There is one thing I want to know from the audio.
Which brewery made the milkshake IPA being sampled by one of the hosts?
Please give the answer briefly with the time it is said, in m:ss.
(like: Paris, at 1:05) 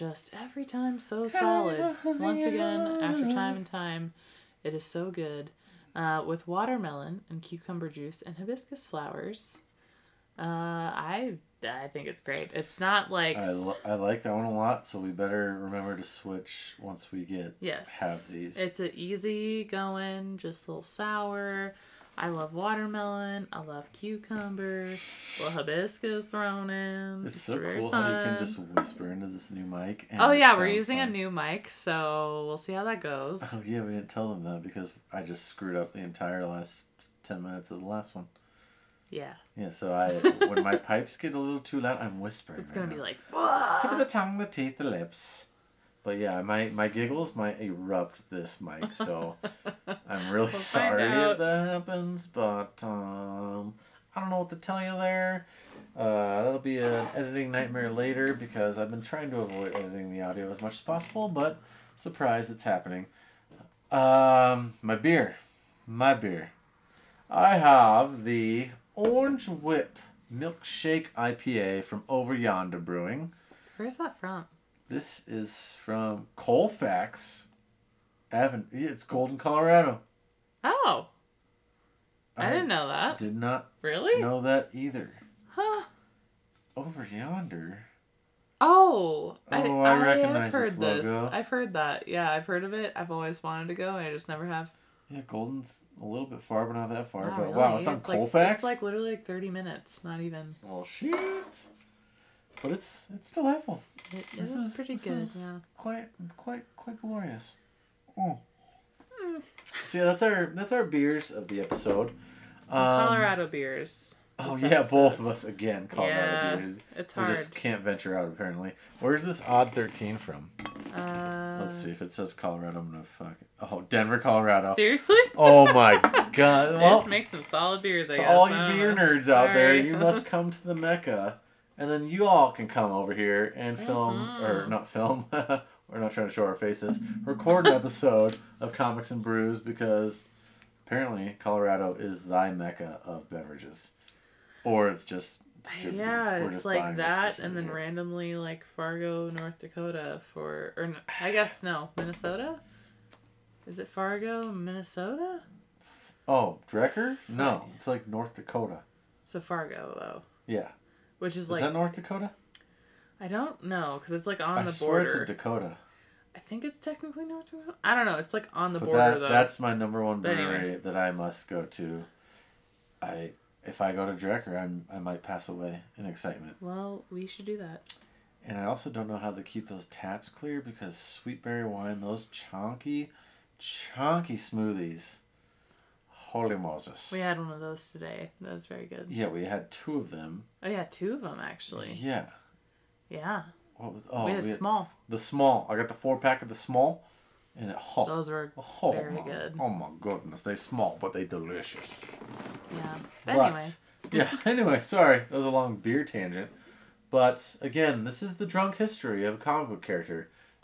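Over Yonder Brewing, at 1:12.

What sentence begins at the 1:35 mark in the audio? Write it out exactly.
Yeah, Golden's a little bit far, but not that far.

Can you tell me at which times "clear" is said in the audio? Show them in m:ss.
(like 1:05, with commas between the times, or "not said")
3:00.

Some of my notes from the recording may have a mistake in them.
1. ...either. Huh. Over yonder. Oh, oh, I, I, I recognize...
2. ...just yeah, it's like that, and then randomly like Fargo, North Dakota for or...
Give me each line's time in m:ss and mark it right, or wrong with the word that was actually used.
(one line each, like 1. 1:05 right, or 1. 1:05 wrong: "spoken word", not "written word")
1. 1:24 right
2. 2:25 right.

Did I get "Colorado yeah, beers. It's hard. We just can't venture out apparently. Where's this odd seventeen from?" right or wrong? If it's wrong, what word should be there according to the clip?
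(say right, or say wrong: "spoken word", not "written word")
wrong: "thirteen", not "seventeen".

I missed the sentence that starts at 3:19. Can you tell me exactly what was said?
Oh my goodness, they small, but they delicious.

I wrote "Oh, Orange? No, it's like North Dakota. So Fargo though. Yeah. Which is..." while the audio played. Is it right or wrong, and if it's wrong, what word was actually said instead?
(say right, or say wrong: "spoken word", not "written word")
wrong: "Drekker", not "Orange".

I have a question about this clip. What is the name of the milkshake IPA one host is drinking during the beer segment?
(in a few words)
Orange Whip.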